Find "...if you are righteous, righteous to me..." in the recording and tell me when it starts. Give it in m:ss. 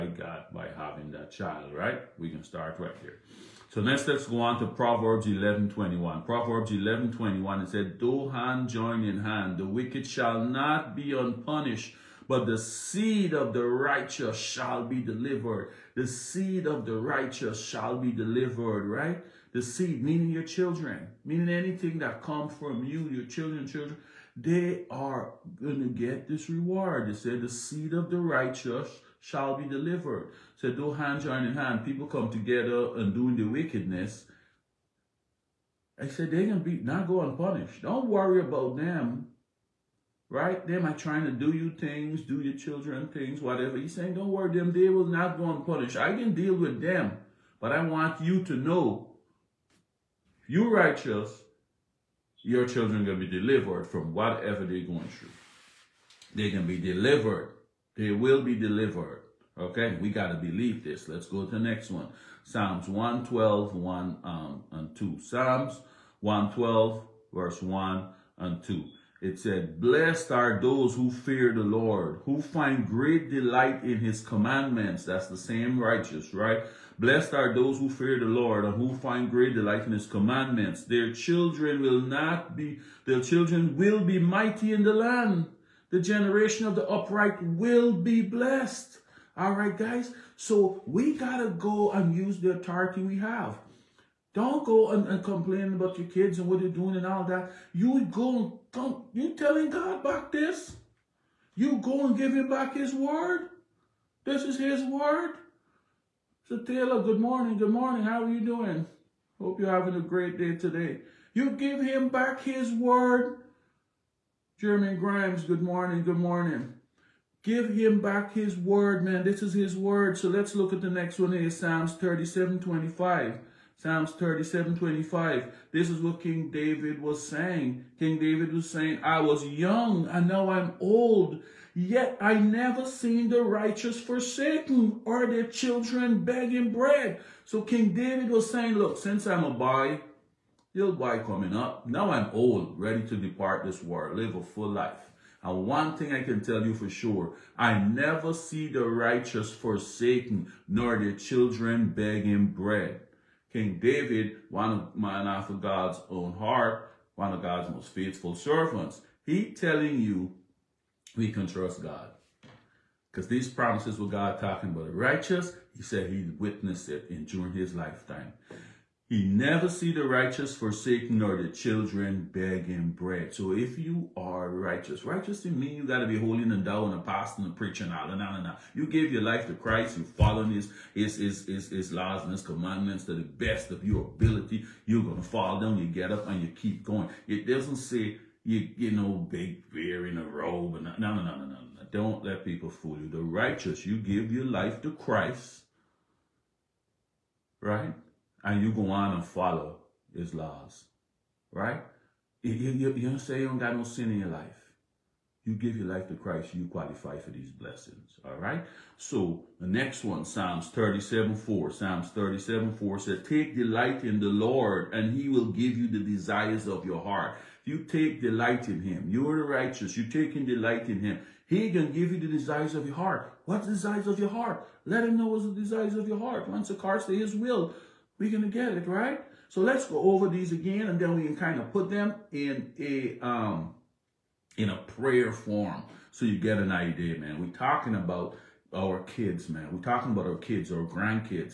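2:53.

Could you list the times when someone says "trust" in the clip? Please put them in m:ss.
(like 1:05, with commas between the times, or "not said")
2:41.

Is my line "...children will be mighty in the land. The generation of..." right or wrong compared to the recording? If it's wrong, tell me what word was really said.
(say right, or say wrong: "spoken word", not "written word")
right.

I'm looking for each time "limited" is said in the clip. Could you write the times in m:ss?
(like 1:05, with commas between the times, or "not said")
not said.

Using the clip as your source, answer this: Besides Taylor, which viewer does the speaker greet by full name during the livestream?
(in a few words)
Jeremy Grimes.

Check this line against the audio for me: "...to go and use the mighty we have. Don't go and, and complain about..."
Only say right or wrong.
wrong.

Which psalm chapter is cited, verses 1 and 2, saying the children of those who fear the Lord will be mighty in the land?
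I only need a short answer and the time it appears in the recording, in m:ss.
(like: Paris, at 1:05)
Psalms 112, at 1:05.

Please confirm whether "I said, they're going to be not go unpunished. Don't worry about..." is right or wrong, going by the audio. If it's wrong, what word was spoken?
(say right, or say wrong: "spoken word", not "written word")
right.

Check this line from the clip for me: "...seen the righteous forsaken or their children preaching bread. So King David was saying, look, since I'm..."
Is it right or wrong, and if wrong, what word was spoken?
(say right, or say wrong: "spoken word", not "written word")
wrong: "begging", not "preaching".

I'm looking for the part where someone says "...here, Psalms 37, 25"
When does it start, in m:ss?
2:01.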